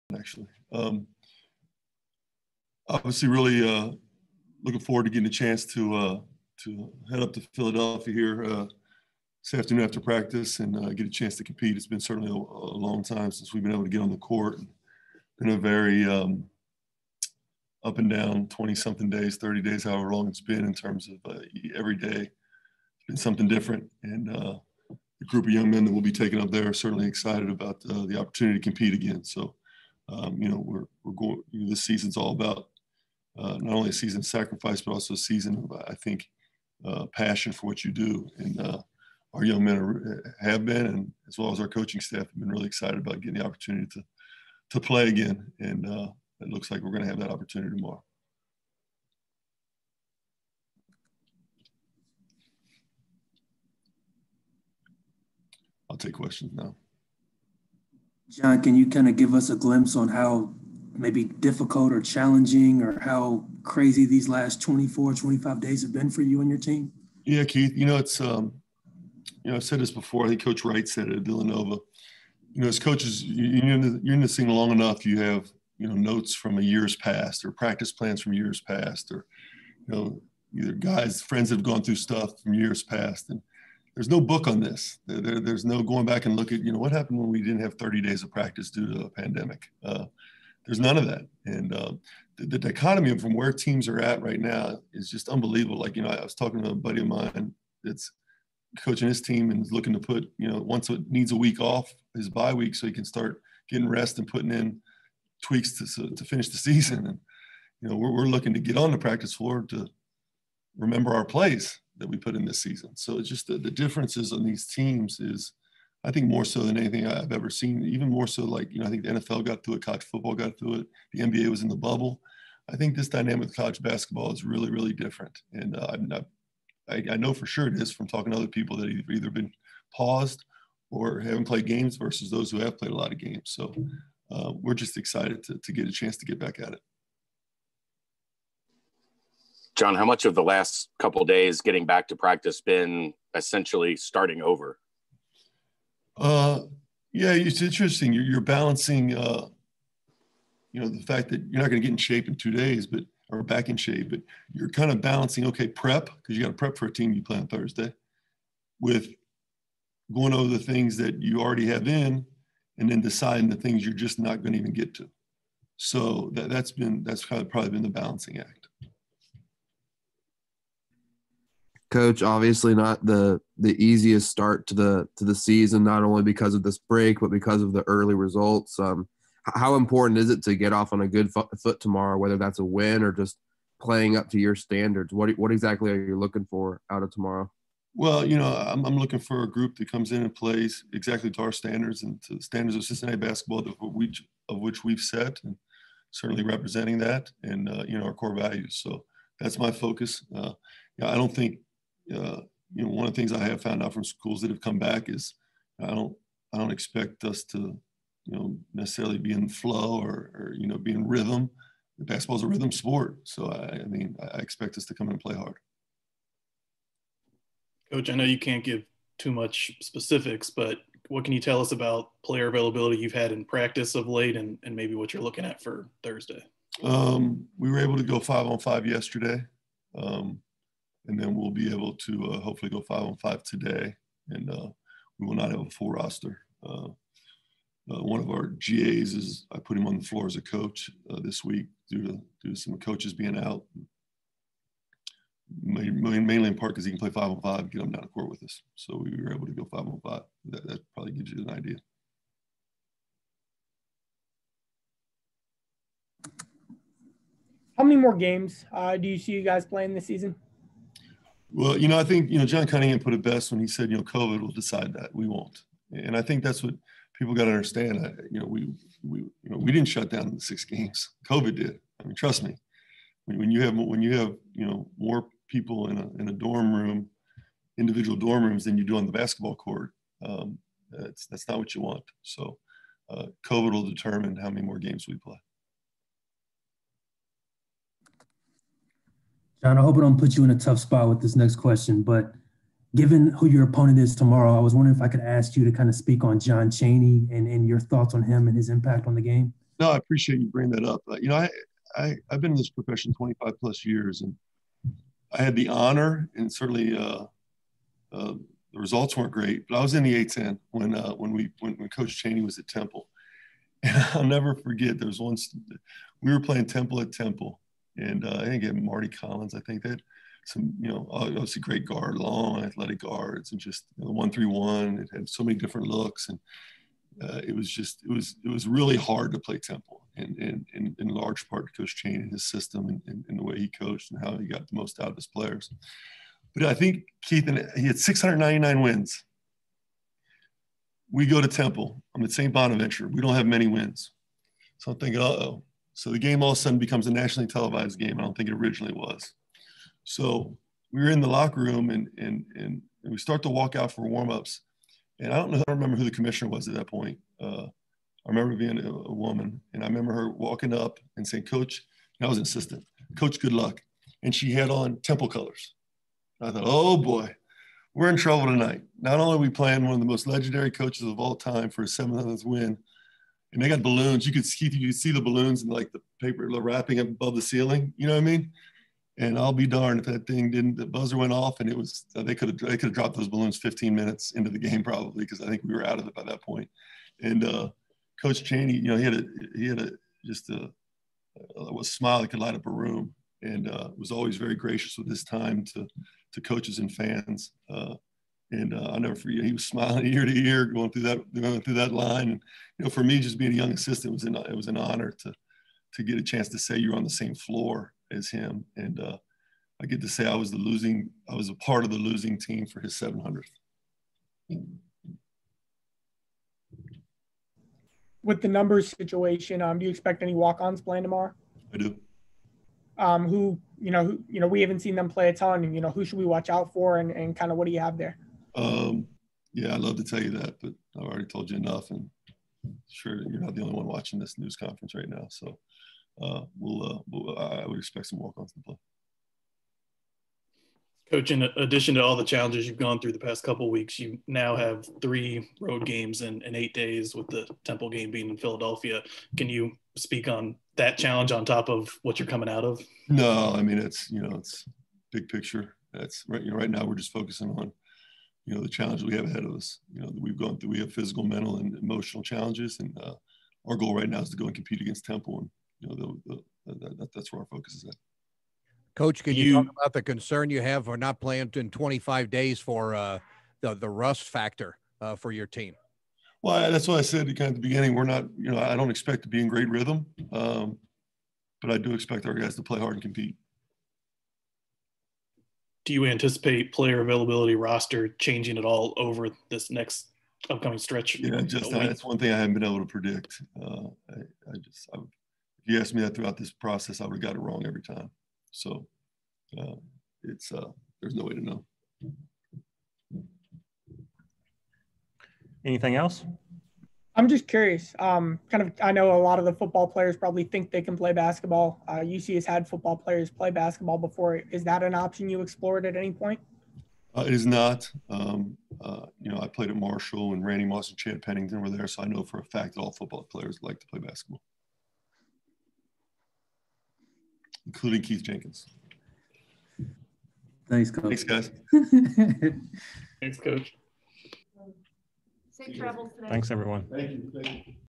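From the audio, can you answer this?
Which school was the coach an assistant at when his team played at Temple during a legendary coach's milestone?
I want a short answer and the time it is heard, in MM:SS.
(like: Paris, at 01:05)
St. Bonaventure, at 05:42.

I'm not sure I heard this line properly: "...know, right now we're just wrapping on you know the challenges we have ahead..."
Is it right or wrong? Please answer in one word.
wrong.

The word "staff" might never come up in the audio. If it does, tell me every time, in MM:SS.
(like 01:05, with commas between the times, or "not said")
00:42.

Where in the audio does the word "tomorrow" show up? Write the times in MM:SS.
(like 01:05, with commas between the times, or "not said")
00:47, 03:01, 03:07, 04:54, 07:01.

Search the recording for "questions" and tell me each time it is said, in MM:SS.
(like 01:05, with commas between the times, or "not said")
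00:56, 04:51.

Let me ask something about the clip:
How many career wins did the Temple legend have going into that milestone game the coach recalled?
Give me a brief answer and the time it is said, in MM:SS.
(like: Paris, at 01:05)
699, at 05:37.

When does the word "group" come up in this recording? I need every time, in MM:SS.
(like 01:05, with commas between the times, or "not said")
00:25, 03:09.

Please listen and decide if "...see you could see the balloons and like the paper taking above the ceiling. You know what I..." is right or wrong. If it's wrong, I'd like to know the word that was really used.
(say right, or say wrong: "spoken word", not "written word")
wrong: "wrapping", not "taking".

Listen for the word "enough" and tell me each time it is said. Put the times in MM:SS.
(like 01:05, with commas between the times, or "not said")
01:14, 07:11.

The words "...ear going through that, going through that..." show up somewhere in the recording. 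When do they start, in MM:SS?
06:40.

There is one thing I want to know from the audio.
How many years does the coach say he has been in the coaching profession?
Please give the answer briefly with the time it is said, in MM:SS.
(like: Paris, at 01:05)
25 plus years, at 05:03.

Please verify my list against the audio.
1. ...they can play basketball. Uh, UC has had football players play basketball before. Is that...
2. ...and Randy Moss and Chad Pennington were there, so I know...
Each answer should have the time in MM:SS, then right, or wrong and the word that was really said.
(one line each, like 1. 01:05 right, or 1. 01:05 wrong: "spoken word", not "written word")
1. 08:30 right
2. 08:40 right.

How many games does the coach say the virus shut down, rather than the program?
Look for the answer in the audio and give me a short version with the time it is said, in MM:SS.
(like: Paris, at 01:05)
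6, at 04:30.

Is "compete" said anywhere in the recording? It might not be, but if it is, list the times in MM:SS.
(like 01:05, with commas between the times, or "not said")
00:11, 00:28, 07:44, 08:03.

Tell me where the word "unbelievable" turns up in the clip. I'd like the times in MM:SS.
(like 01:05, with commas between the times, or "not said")
01:35.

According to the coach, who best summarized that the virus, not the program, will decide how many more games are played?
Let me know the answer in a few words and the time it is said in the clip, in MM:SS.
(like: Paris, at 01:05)
John Cunningham, at 04:22.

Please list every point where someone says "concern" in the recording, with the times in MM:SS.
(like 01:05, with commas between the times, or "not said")
07:50.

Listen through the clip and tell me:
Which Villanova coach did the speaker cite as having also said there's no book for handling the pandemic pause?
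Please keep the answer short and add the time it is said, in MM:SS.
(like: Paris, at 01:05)
Coach Wright, at 01:10.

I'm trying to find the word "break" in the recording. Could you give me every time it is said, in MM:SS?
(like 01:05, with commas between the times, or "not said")
02:56.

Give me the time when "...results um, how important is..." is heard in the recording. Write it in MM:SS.
02:58.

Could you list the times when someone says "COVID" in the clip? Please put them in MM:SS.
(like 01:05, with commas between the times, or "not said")
04:24, 04:31, 04:43.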